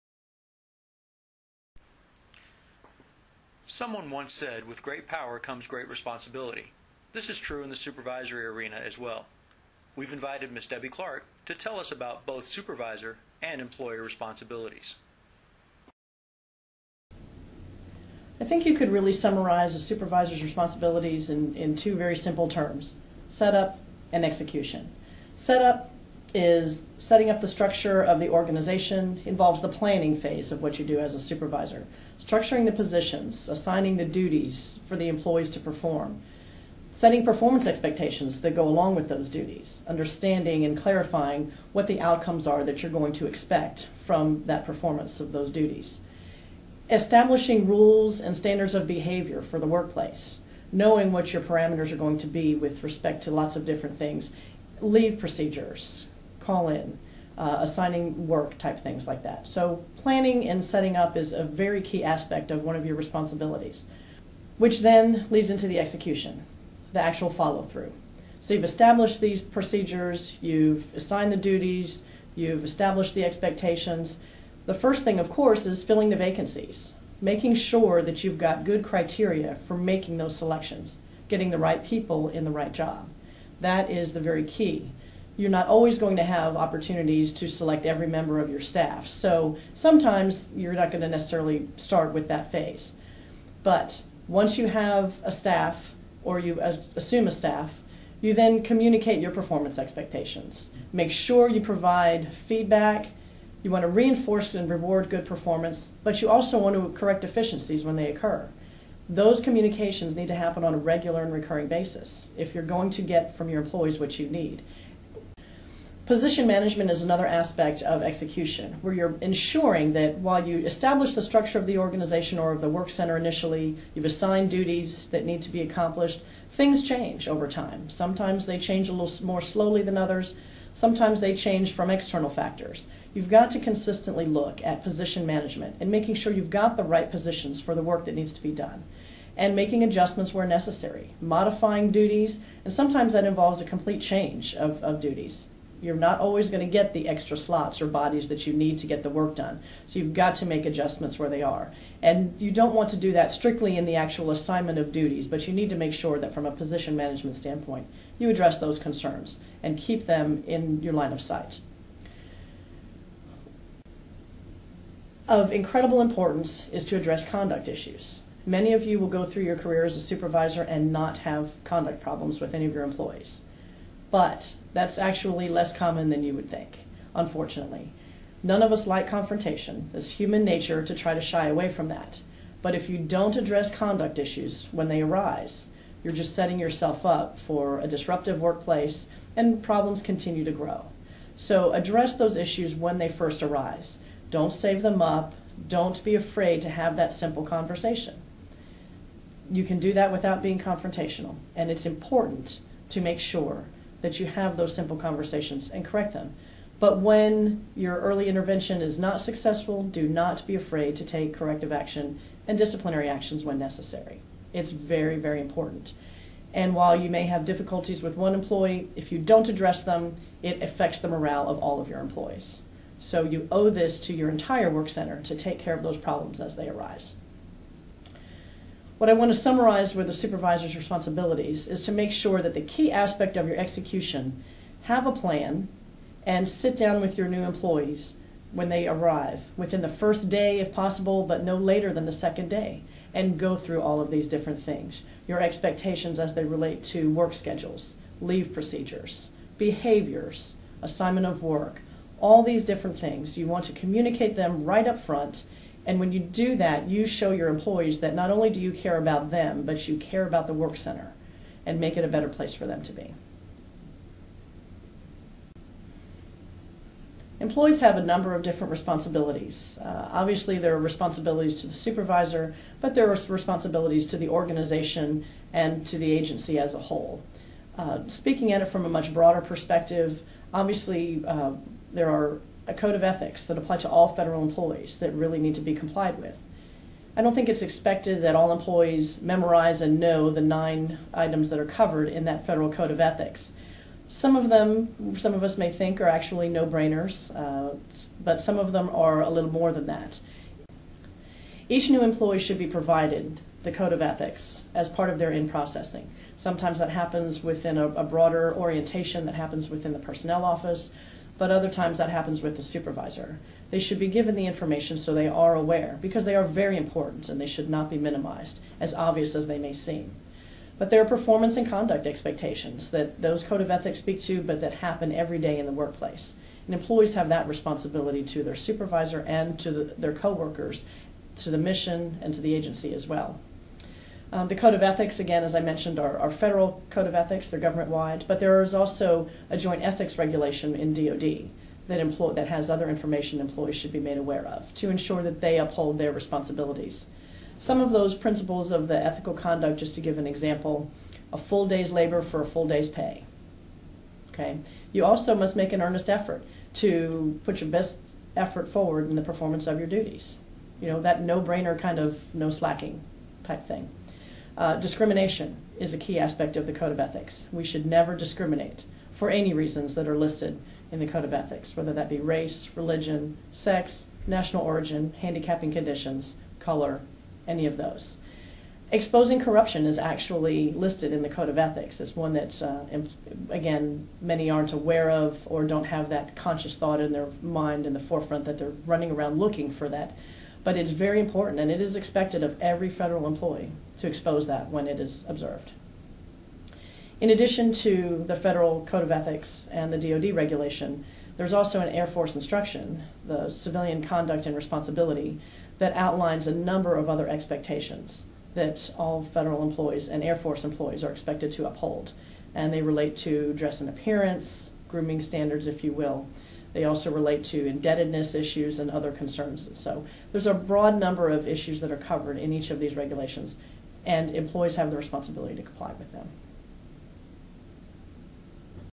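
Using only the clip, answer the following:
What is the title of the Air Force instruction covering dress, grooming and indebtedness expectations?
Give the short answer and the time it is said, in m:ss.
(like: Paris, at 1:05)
Civilian Conduct and Responsibility, at 6:43.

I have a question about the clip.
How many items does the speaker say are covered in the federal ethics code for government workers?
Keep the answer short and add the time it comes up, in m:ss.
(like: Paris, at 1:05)
9, at 4:50.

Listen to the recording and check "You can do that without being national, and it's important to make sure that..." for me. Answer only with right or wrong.
wrong.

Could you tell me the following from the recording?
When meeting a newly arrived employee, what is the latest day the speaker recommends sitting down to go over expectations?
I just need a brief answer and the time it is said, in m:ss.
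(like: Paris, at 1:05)
Second day, at 4:02.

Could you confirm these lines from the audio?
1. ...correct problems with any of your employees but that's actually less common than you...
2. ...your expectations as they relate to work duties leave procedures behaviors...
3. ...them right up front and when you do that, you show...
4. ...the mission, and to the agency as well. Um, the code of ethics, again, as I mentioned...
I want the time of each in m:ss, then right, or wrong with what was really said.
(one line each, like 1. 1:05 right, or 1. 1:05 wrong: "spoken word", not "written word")
1. 2:51 wrong: "conduct", not "correct"
2. 4:05 wrong: "schedules", not "duties"
3. 4:14 right
4. 5:31 right.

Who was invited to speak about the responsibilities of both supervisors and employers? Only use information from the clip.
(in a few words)
Debbie Clark.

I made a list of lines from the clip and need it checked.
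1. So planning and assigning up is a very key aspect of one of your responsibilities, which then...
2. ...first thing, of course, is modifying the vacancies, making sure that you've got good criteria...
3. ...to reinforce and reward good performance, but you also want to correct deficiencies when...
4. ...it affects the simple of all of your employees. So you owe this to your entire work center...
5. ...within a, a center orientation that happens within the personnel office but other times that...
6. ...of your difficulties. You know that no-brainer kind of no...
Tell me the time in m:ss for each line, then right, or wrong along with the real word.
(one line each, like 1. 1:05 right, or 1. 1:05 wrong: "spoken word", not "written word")
1. 0:59 wrong: "setting", not "assigning"
2. 1:14 wrong: "filling", not "modifying"
3. 1:43 right
4. 3:40 wrong: "morale", not "simple"
5. 5:07 wrong: "broader", not "center"
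6. 5:59 wrong: "duties", not "difficulties".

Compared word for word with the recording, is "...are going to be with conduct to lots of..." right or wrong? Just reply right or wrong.
wrong.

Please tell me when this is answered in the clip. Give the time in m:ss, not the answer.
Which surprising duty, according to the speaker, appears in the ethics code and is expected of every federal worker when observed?
6:18.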